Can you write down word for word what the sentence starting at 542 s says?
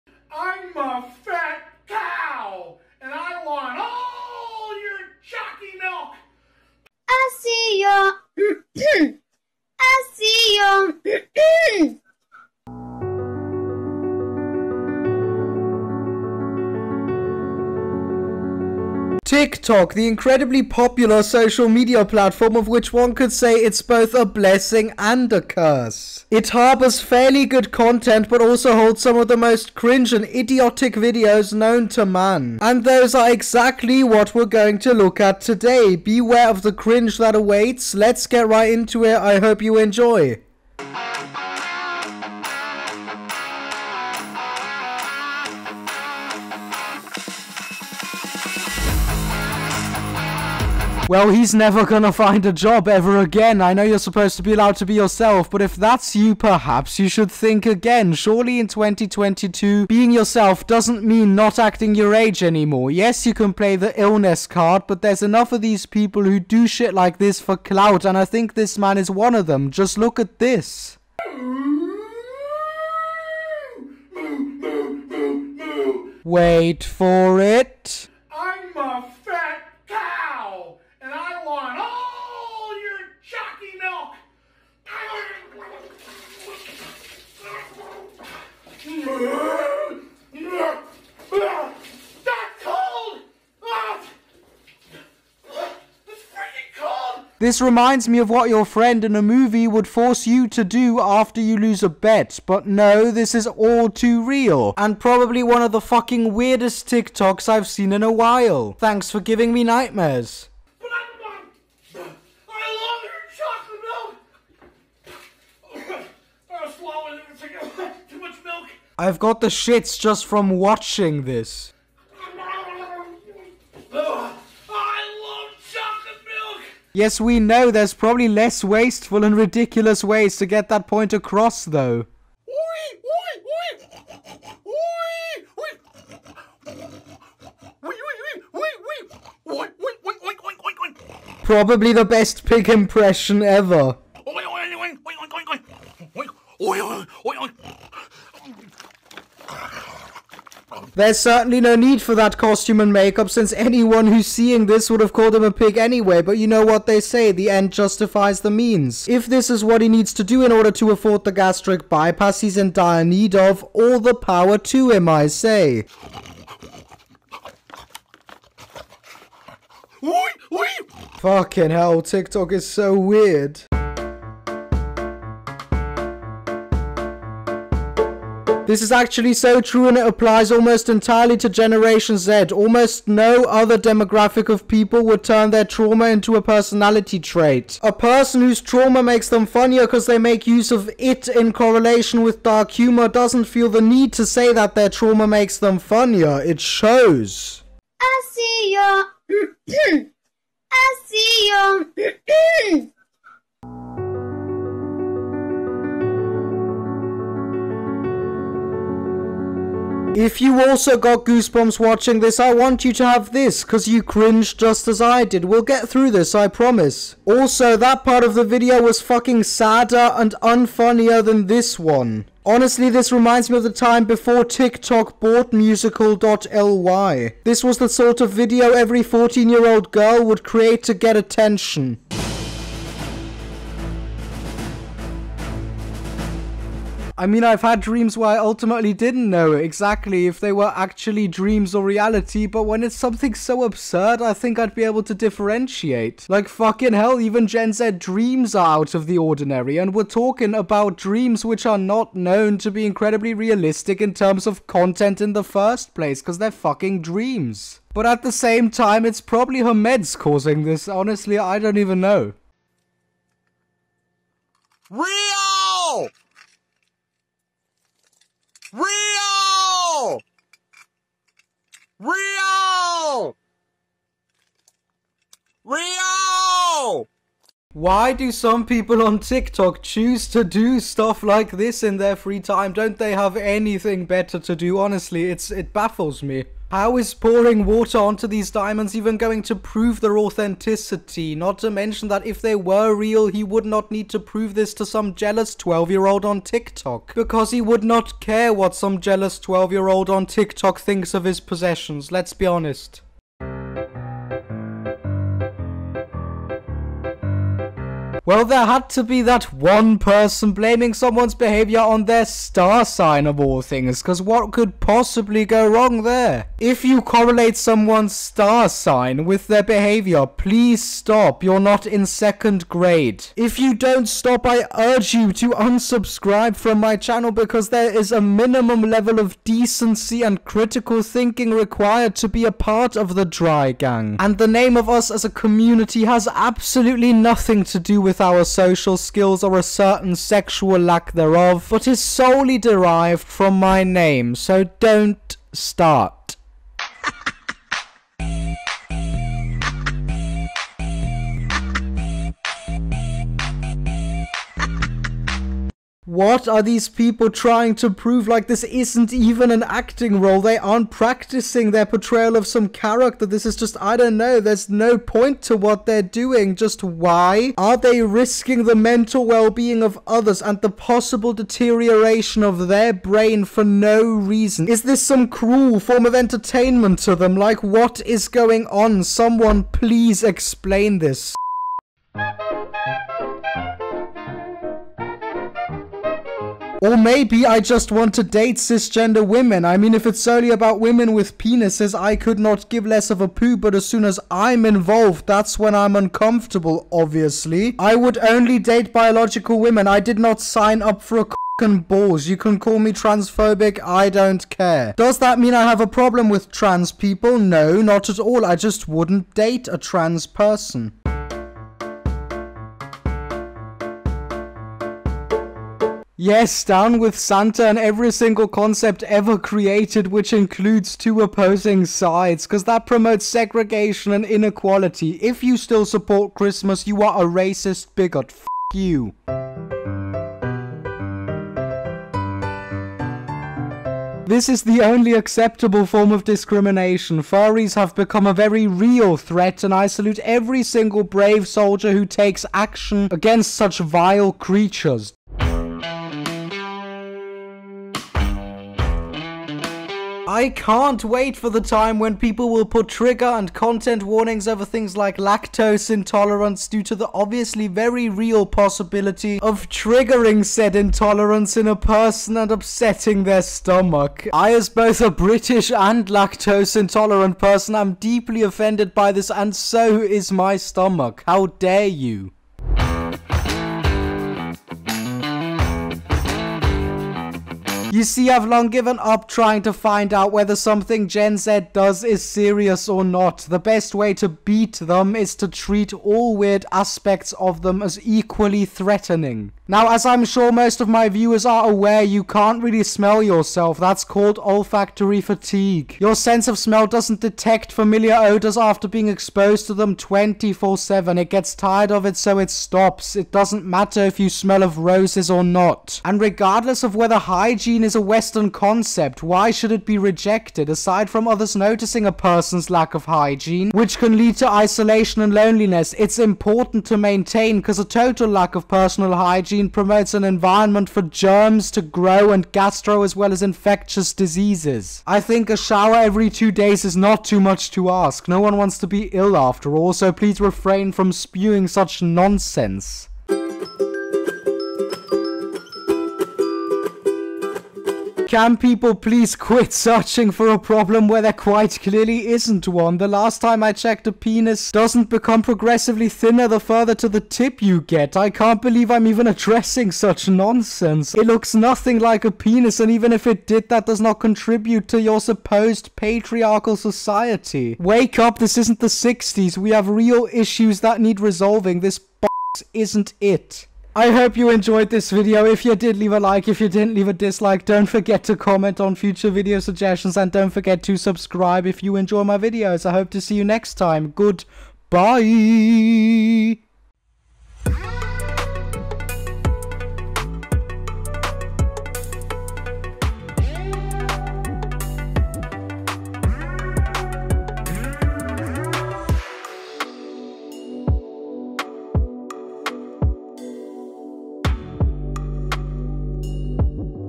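The last time I checked, a penis doesn't become progressively thinner the further to the tip you get.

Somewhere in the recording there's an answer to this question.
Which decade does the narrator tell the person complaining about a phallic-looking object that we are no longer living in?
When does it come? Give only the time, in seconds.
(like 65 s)
558 s.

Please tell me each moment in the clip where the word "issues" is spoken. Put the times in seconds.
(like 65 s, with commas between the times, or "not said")
560 s.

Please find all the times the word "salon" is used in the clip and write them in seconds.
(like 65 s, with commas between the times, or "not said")
not said.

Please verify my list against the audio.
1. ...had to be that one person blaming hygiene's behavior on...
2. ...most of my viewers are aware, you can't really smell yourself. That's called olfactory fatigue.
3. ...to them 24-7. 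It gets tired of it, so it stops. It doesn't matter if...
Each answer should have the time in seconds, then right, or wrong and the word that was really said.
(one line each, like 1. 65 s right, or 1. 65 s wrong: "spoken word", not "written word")
1. 308 s wrong: "someone", not "hygiene"
2. 490 s right
3. 499 s right.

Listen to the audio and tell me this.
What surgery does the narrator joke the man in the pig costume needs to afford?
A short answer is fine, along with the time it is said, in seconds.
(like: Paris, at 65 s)
Gastric bypass, at 161 s.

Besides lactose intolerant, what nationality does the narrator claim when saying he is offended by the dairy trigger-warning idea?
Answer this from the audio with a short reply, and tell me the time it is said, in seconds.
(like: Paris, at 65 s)
British, at 465 s.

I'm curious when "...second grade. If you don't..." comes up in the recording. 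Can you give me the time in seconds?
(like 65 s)
322 s.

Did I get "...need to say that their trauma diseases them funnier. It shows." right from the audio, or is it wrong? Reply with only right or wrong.
wrong.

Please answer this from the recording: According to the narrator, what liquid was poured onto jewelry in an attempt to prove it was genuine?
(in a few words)
Water.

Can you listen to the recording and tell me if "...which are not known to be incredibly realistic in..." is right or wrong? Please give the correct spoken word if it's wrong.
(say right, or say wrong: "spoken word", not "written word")
right.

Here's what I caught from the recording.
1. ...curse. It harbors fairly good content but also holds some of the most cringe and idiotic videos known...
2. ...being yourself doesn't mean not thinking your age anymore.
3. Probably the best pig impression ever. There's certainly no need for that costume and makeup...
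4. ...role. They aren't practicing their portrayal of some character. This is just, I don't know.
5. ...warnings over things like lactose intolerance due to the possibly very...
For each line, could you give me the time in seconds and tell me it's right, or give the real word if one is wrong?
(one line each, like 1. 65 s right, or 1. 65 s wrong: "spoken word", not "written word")
1. 25 s right
2. 59 s wrong: "acting", not "thinking"
3. 141 s right
4. 360 s right
5. 454 s wrong: "obviously", not "possibly".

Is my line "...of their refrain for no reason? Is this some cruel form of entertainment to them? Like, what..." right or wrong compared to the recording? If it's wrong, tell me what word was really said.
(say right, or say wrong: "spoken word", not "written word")
wrong: "brain", not "refrain".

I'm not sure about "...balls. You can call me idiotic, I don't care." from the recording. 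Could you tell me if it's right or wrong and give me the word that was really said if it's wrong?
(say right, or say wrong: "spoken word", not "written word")
wrong: "transphobic", not "idiotic".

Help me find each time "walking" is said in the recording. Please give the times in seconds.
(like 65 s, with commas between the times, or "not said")
not said.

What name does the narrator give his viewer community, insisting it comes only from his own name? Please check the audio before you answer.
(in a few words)
Dry Gang.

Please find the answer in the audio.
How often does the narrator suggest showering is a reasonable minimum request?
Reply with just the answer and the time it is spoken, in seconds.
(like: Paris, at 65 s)
Every two days, at 525 s.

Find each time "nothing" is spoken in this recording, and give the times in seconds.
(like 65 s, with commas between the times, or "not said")
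337 s, 551 s.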